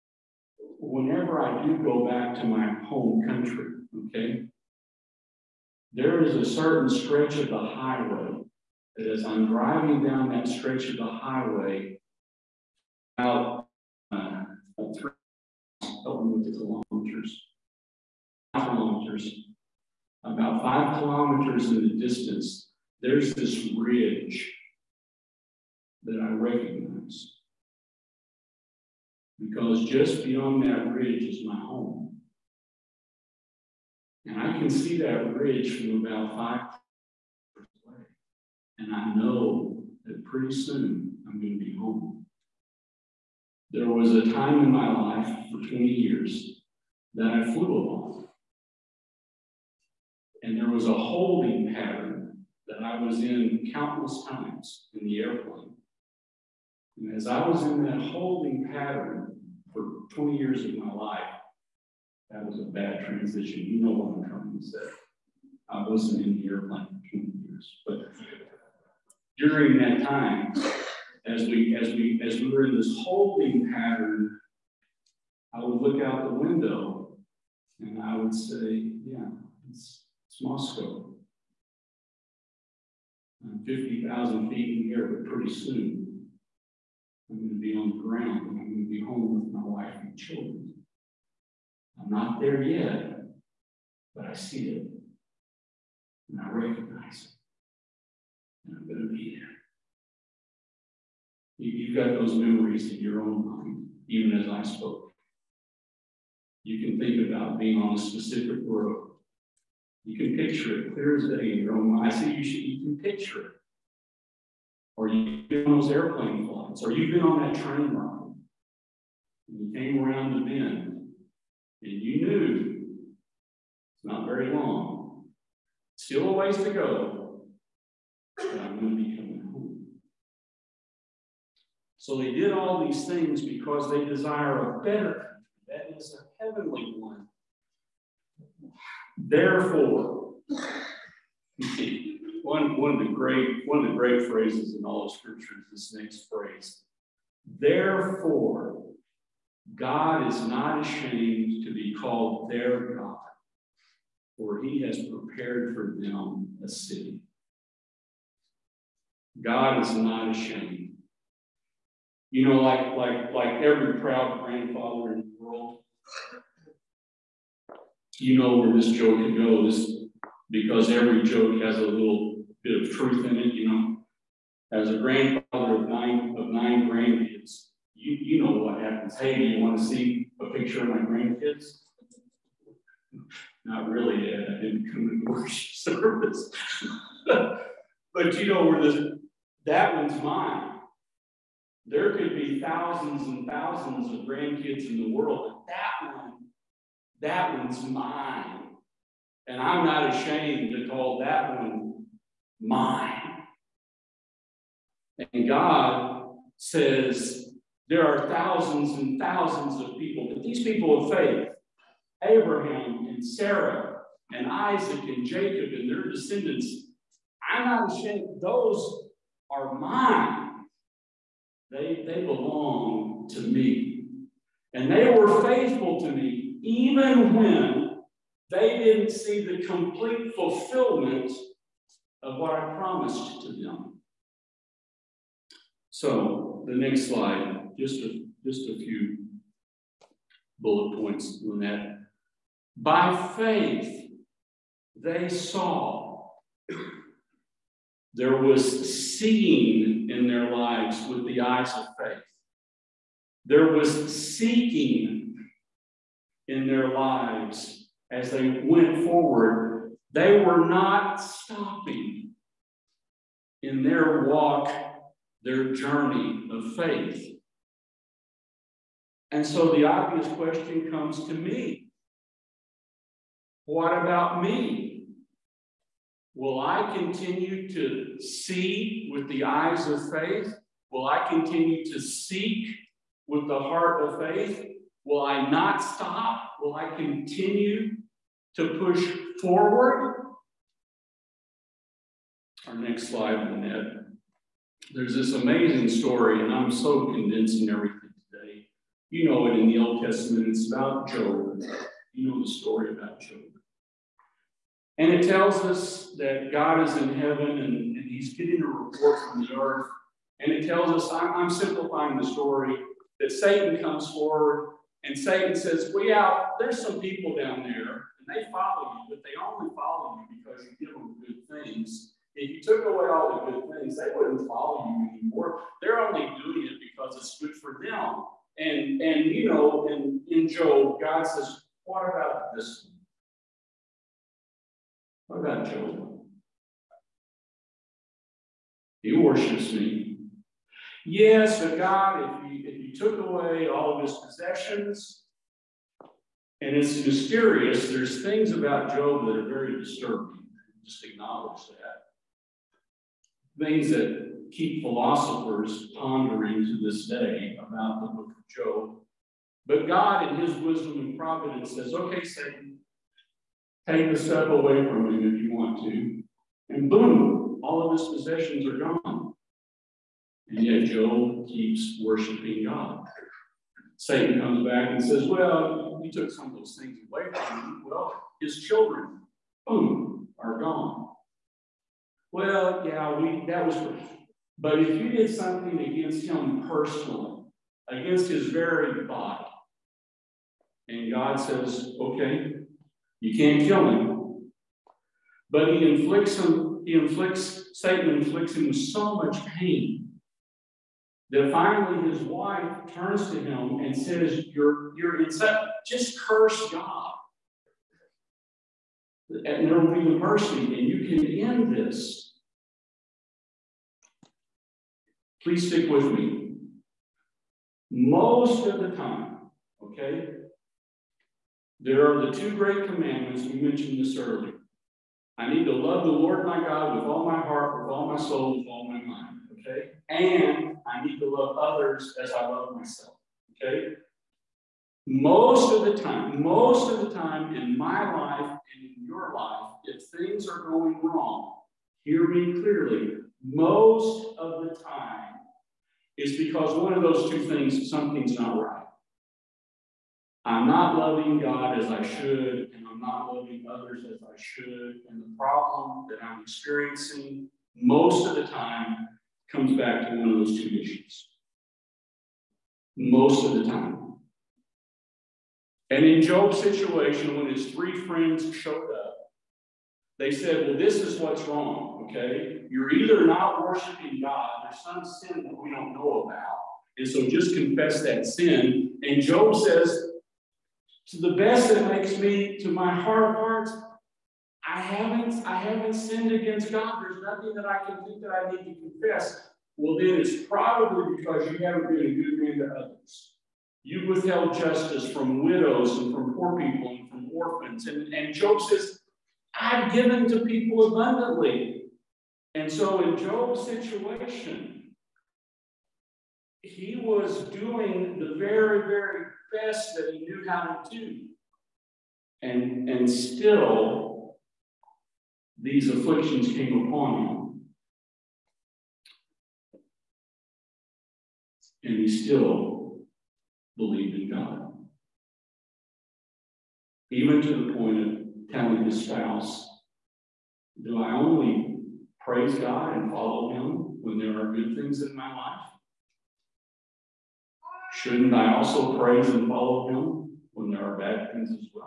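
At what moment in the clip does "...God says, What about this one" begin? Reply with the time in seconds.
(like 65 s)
331 s.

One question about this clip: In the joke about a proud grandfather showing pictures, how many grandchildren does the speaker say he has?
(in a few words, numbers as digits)
9.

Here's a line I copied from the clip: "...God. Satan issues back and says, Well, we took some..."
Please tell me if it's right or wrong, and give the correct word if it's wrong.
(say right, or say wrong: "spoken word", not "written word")
wrong: "comes", not "issues".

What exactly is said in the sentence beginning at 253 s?
There was seeking in their lives as they went forward, they were not stopping in their walk, their journey of faith.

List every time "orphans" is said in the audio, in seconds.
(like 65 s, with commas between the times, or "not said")
497 s.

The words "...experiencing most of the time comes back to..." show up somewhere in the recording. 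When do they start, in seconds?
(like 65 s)
456 s.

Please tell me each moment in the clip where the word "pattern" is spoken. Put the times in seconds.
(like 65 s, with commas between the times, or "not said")
51 s, 58 s, 73 s.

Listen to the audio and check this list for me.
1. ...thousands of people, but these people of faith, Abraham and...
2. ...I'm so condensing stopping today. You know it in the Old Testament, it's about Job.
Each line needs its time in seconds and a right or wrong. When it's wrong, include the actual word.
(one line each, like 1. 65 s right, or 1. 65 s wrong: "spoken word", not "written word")
1. 209 s right
2. 296 s wrong: "everything", not "stopping".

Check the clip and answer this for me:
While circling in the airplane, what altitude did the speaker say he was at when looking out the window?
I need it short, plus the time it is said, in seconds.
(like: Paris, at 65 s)
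50,000 feet, at 83 s.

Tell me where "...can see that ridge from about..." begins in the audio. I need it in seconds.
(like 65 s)
34 s.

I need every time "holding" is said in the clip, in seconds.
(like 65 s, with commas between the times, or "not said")
50 s, 58 s, 73 s.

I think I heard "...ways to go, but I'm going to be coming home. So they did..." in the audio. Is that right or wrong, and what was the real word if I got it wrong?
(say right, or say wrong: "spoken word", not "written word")
right.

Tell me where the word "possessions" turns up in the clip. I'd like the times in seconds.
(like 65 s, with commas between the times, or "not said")
344 s, 368 s.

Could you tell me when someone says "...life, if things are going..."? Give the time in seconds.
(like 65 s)
439 s.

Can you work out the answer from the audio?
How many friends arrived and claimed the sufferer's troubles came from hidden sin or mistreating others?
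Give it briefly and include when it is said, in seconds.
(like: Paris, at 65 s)
3, at 467 s.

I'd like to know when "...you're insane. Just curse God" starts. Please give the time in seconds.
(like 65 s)
404 s.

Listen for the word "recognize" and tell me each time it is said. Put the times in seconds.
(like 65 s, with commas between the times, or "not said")
26 s, 96 s.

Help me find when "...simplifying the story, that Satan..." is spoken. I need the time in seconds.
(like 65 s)
311 s.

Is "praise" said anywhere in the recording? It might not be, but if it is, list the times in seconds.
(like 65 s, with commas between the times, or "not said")
532 s, 538 s.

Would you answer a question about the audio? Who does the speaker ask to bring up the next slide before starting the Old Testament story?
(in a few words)
Lynette.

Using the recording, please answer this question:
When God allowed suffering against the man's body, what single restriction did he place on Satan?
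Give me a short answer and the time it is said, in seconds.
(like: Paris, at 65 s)
can't kill him, at 393 s.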